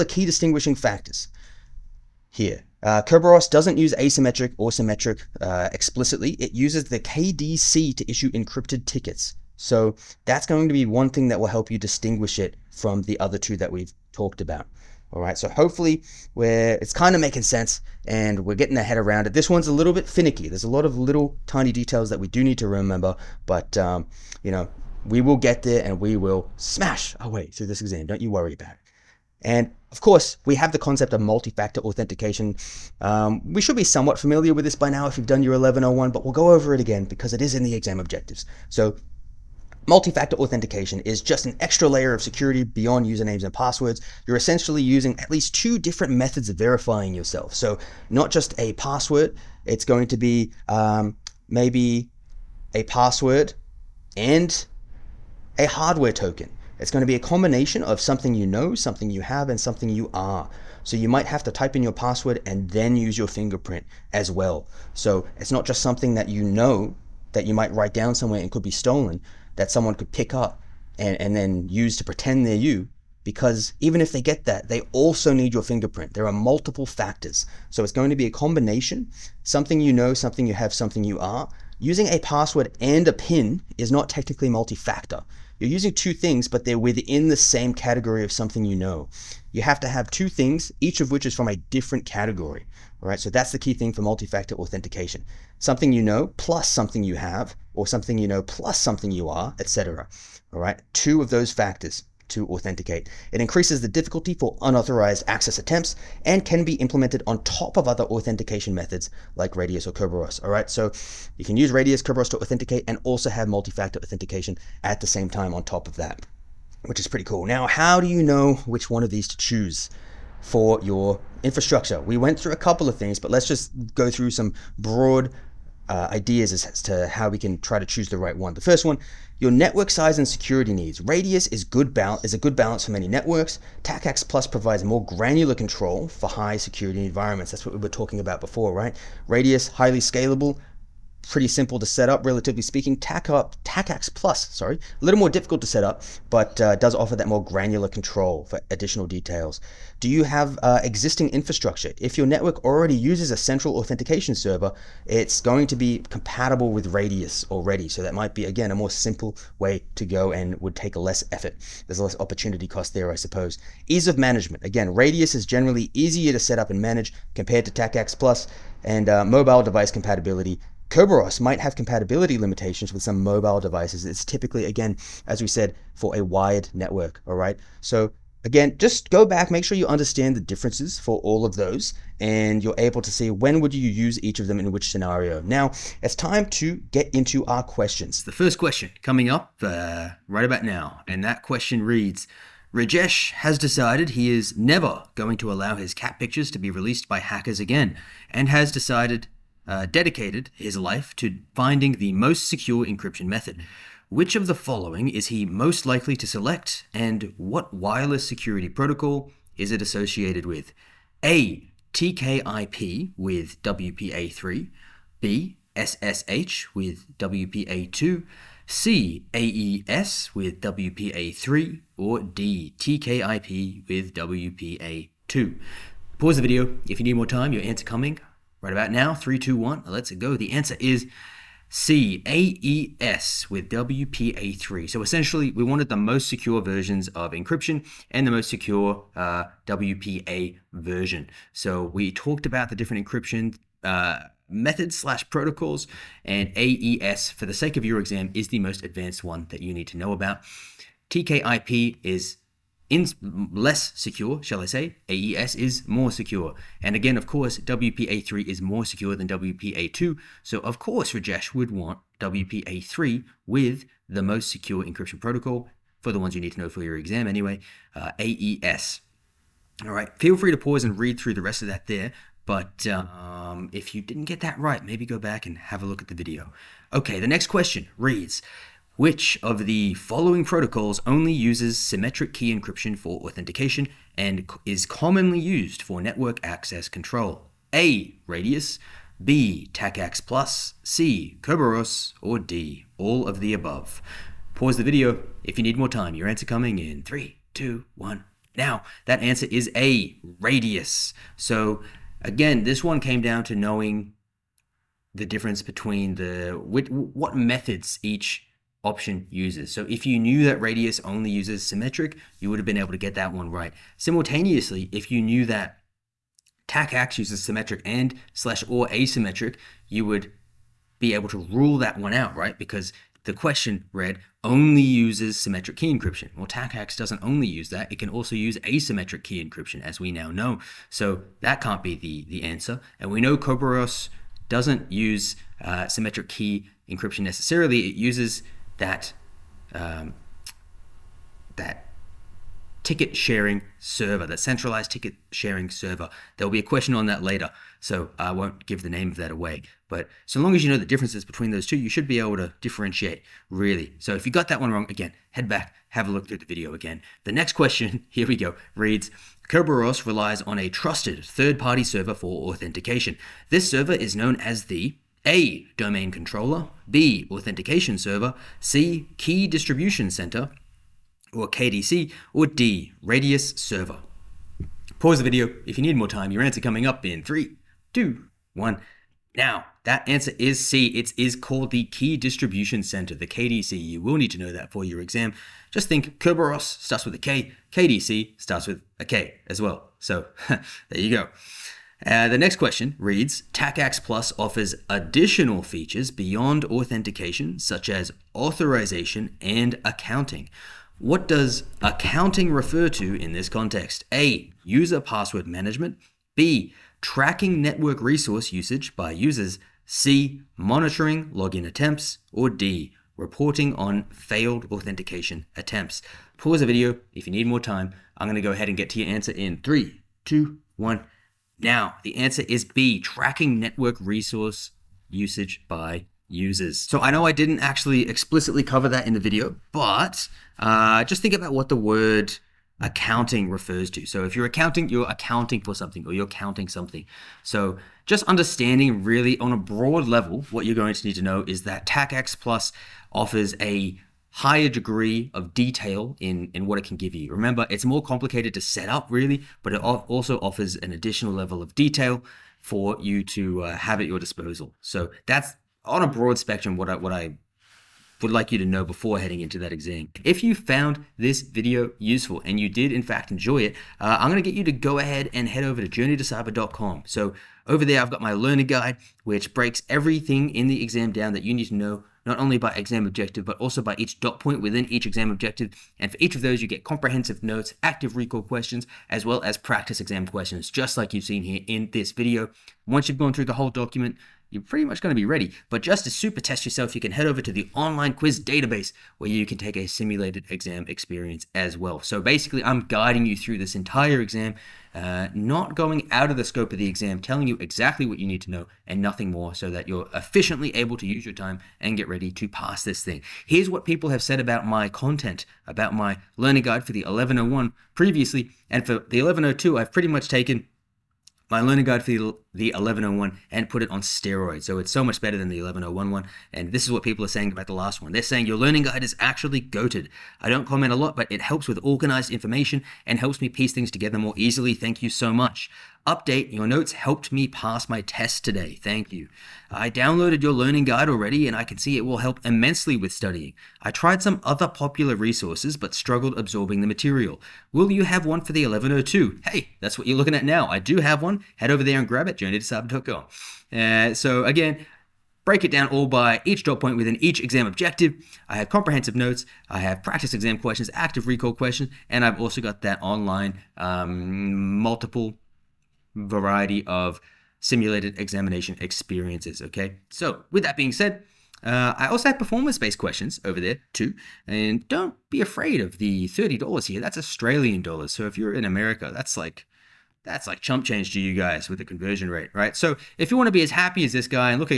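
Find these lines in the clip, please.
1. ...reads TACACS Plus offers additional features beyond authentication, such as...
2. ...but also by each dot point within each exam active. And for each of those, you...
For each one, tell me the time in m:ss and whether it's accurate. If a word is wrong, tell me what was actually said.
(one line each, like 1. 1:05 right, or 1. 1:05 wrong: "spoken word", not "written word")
1. 6:32 right
2. 7:53 wrong: "objective", not "active".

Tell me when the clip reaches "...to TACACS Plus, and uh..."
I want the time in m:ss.
2:47.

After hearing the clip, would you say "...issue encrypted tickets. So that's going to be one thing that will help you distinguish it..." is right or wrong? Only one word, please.
right.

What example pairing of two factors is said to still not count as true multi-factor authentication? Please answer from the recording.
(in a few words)
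A password and a PIN.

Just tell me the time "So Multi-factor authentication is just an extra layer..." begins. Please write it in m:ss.
0:38.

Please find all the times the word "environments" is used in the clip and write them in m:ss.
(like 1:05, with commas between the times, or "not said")
2:17.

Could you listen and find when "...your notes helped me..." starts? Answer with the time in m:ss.
8:46.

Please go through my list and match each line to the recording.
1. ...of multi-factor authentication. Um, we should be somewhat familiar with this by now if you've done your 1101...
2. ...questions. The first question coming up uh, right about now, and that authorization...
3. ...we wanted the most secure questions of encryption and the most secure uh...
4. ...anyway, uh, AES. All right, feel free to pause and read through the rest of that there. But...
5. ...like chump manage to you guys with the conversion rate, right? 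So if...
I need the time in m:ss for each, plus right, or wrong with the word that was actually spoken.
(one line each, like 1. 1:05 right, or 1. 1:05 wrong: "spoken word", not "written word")
1. 0:31 right
2. 3:07 wrong: "question", not "authorization"
3. 3:55 wrong: "versions", not "questions"
4. 4:27 right
5. 9:30 wrong: "change", not "manage".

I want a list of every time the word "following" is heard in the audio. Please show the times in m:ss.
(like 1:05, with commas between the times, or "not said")
3:24, 4:39.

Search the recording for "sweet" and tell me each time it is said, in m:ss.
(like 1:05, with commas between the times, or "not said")
not said.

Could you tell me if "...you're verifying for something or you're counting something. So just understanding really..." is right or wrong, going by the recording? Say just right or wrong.
wrong.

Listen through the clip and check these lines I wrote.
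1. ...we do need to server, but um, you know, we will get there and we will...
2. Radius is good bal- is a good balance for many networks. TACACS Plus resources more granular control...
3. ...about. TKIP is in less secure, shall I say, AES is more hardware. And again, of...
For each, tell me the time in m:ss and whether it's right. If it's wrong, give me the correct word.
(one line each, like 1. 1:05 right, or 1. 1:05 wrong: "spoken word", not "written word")
1. 0:22 wrong: "remember", not "server"
2. 2:11 wrong: "provides", not "resources"
3. 4:10 wrong: "secure", not "hardware".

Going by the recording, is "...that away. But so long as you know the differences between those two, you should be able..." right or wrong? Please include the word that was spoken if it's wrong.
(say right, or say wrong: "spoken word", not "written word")
right.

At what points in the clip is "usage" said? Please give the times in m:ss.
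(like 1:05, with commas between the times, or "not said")
6:48, 7:05.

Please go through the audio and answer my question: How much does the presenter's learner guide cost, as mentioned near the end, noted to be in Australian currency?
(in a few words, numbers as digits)
30 dollars.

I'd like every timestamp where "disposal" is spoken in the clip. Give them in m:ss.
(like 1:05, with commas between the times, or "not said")
7:34.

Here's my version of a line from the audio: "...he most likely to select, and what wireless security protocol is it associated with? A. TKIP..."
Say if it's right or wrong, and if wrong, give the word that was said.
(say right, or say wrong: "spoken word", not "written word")
right.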